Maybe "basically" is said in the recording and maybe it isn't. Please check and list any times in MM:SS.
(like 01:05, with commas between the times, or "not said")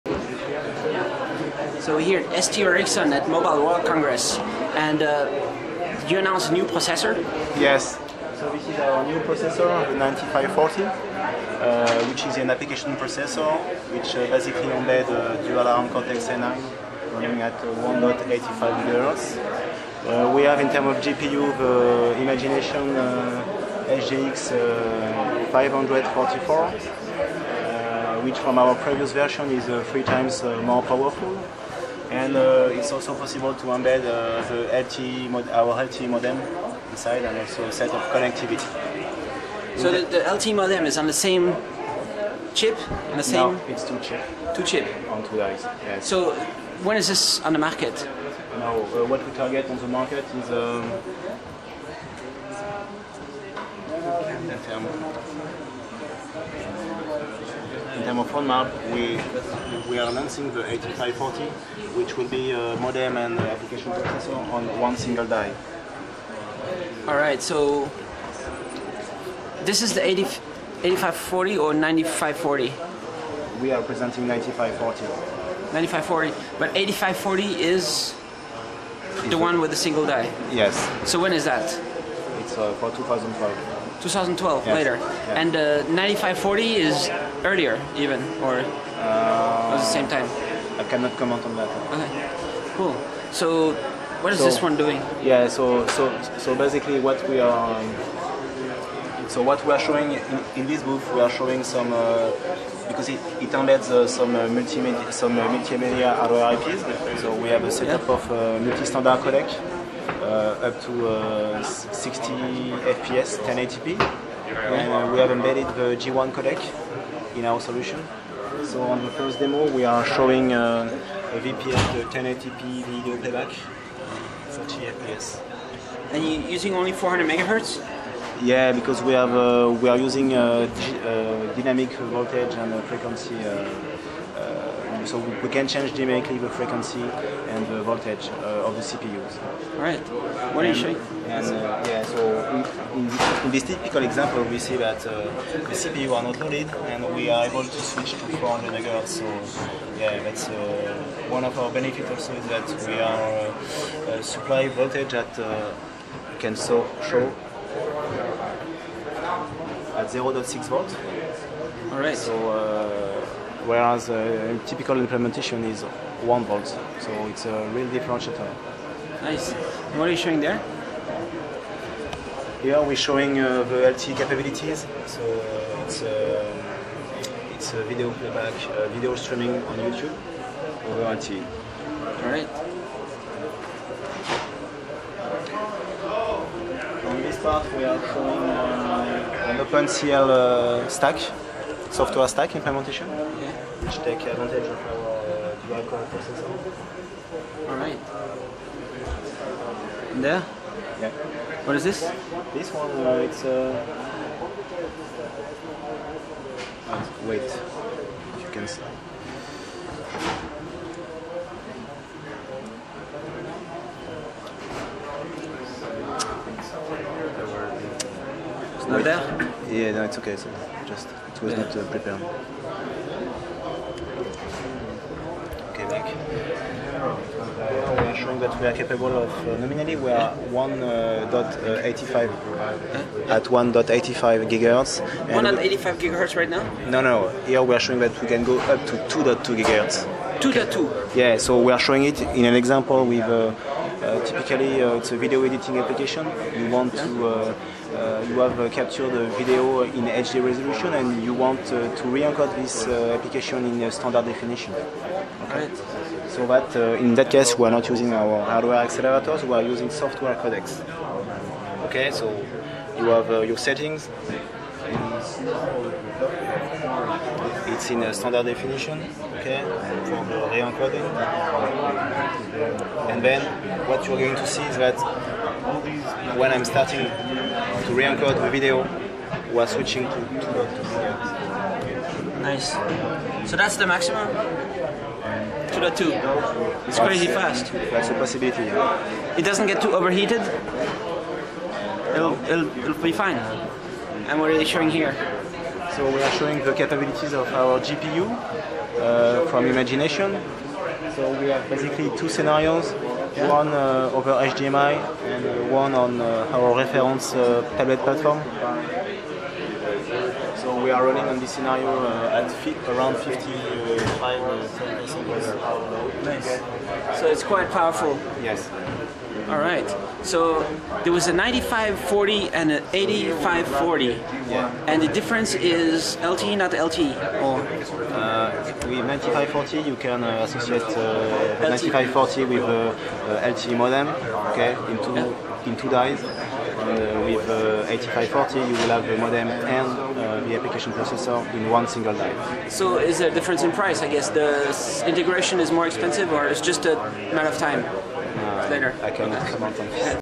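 00:14, 01:36, 05:01.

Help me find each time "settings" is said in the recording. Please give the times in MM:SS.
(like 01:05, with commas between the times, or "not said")
04:23.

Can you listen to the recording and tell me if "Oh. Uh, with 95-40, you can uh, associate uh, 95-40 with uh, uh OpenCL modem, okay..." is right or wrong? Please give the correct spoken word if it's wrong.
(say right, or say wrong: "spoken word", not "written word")
wrong: "LTE", not "OpenCL".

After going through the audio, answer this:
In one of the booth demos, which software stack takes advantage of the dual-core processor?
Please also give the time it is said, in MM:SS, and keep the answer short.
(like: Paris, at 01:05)
OpenCL, at 03:09.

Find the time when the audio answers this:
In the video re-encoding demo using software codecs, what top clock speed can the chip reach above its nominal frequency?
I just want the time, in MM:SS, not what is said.
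03:59.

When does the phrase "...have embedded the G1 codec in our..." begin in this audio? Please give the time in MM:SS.
01:55.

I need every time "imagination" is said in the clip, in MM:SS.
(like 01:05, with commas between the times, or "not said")
00:22, 04:59.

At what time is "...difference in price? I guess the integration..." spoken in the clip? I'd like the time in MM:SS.
05:43.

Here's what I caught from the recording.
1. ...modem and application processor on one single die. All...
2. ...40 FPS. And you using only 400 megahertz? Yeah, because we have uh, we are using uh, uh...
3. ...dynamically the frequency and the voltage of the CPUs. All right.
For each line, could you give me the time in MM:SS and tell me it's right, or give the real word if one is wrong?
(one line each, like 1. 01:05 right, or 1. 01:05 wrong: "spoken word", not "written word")
1. 01:02 right
2. 02:04 right
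3. 02:15 right.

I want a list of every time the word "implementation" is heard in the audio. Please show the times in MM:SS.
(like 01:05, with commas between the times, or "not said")
02:44, 03:12.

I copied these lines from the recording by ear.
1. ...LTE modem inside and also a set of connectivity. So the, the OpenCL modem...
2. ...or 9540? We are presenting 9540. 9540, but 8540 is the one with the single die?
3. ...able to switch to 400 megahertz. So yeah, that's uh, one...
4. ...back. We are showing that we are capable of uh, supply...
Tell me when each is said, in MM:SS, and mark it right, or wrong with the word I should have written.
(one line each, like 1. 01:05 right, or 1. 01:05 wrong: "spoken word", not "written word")
1. 00:35 wrong: "LTE", not "OpenCL"
2. 01:11 right
3. 02:27 right
4. 03:45 wrong: "nominally", not "supply".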